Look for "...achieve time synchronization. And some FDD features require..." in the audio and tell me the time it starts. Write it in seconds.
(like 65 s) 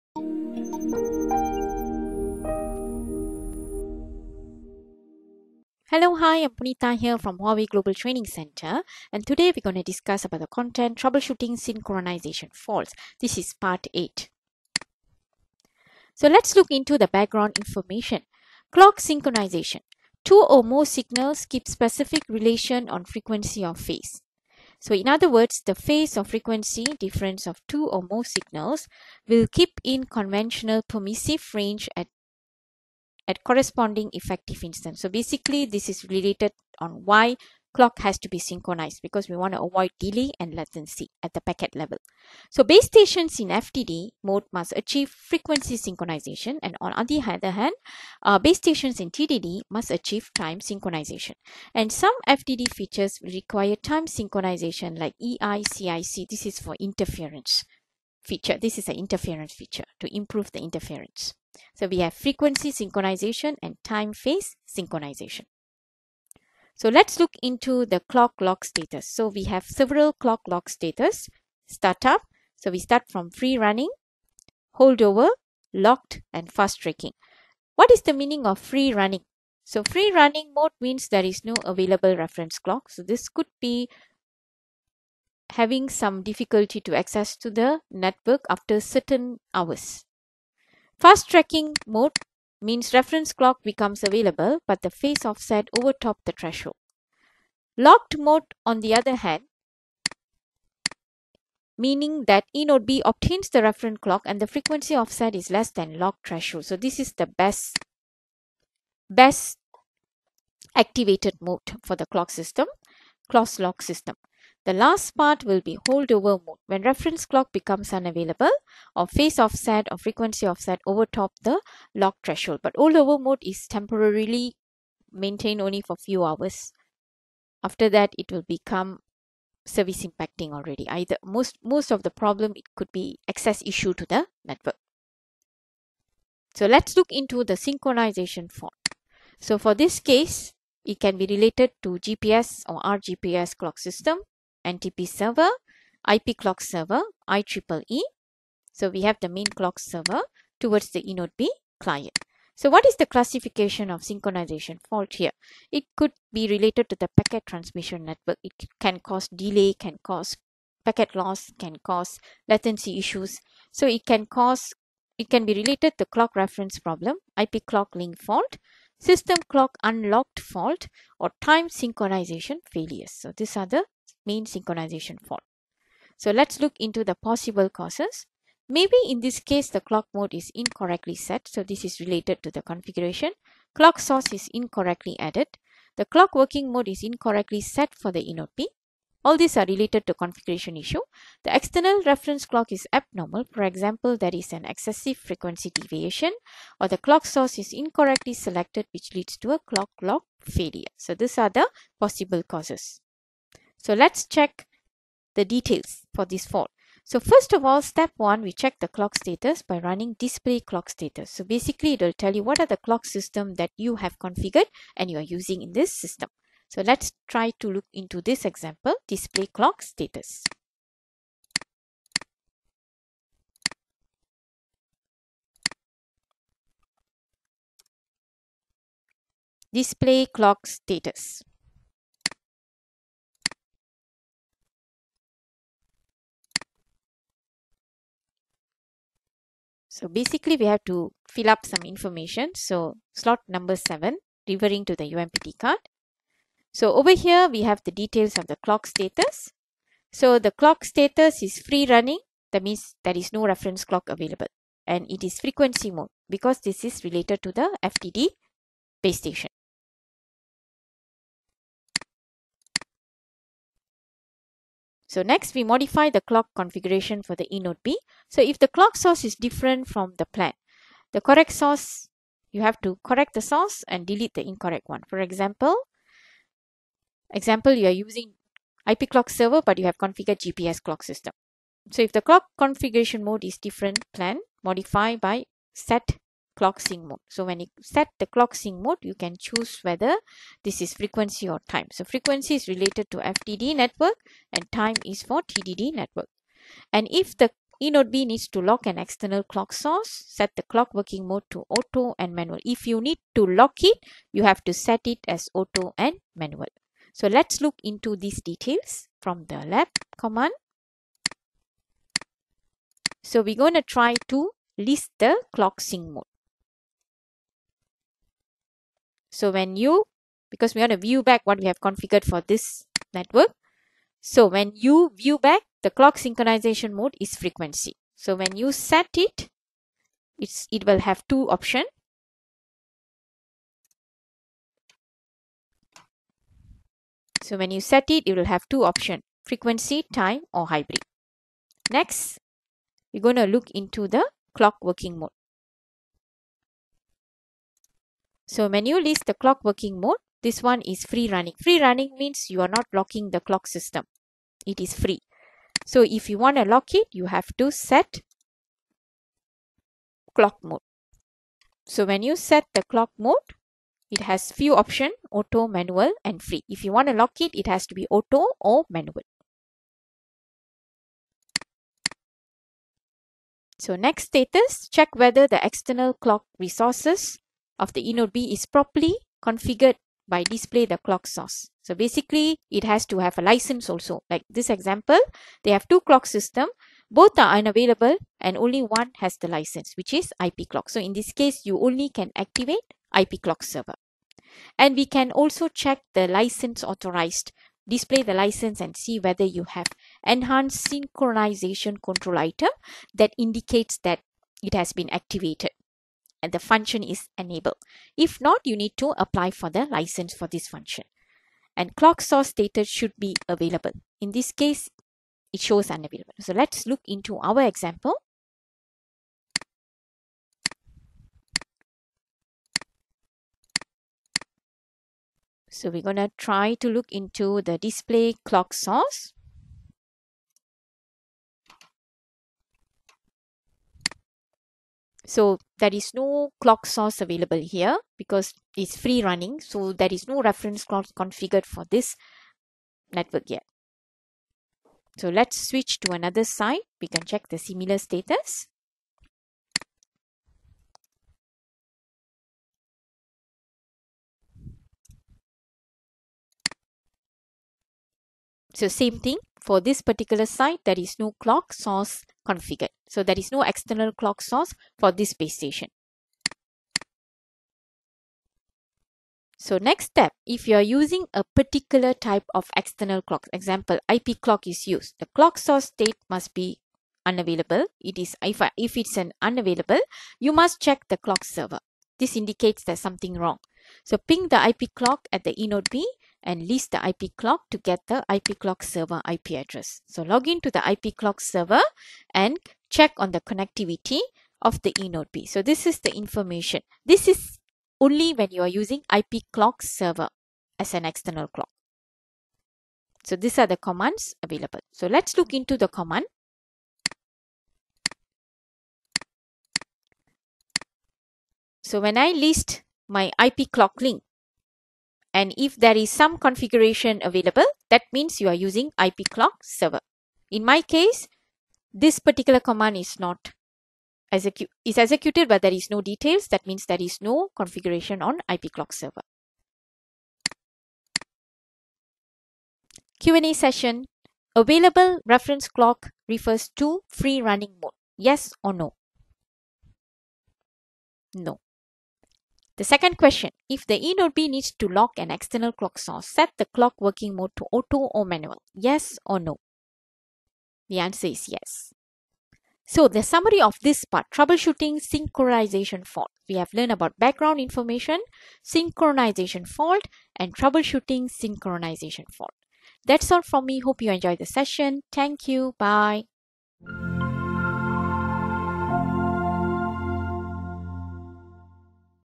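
49 s.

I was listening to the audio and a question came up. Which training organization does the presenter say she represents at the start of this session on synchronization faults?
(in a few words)
Huawei Global Training Center.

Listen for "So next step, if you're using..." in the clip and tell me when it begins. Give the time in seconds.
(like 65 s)
469 s.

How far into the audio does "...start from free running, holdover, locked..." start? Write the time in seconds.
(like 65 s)
72 s.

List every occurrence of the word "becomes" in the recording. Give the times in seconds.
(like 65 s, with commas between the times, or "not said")
93 s, 117 s, 128 s.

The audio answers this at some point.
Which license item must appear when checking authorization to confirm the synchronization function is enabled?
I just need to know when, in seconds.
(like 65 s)
400 s.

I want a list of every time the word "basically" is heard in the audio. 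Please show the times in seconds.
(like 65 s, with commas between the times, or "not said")
35 s, 211 s, 240 s, 381 s.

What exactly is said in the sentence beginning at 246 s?
So over here we have the details of the clock status.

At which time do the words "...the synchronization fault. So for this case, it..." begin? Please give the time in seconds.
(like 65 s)
137 s.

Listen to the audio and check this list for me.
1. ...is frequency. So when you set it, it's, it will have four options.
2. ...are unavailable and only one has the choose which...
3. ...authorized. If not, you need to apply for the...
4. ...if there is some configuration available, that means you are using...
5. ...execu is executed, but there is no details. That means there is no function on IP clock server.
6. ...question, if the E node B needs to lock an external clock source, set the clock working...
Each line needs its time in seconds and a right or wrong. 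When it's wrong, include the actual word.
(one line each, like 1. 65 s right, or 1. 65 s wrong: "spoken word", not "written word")
1. 327 s wrong: "two", not "four"
2. 387 s wrong: "license", not "choose"
3. 407 s wrong: "enabled", not "authorized"
4. 515 s right
5. 524 s wrong: "configuration", not "function"
6. 543 s right.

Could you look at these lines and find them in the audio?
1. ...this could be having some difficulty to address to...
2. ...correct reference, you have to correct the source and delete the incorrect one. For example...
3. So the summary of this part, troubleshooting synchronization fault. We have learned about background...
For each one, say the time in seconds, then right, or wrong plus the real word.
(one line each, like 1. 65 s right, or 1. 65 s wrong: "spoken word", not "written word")
1. 83 s wrong: "access", not "address"
2. 271 s wrong: "source", not "reference"
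3. 552 s right.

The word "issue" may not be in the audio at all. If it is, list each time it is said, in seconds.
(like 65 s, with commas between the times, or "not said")
133 s, 162 s, 190 s.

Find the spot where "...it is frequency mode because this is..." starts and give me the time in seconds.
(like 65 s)
255 s.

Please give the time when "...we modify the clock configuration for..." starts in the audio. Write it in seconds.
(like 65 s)
265 s.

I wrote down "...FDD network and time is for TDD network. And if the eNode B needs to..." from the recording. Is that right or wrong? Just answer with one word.
right.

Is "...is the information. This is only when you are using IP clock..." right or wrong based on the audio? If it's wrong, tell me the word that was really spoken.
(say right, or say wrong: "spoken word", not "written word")
right.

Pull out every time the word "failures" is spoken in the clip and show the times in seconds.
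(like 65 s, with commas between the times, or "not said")
172 s, 200 s.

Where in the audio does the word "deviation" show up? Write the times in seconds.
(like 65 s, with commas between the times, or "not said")
195 s.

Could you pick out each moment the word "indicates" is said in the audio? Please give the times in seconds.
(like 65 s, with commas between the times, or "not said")
403 s, 482 s.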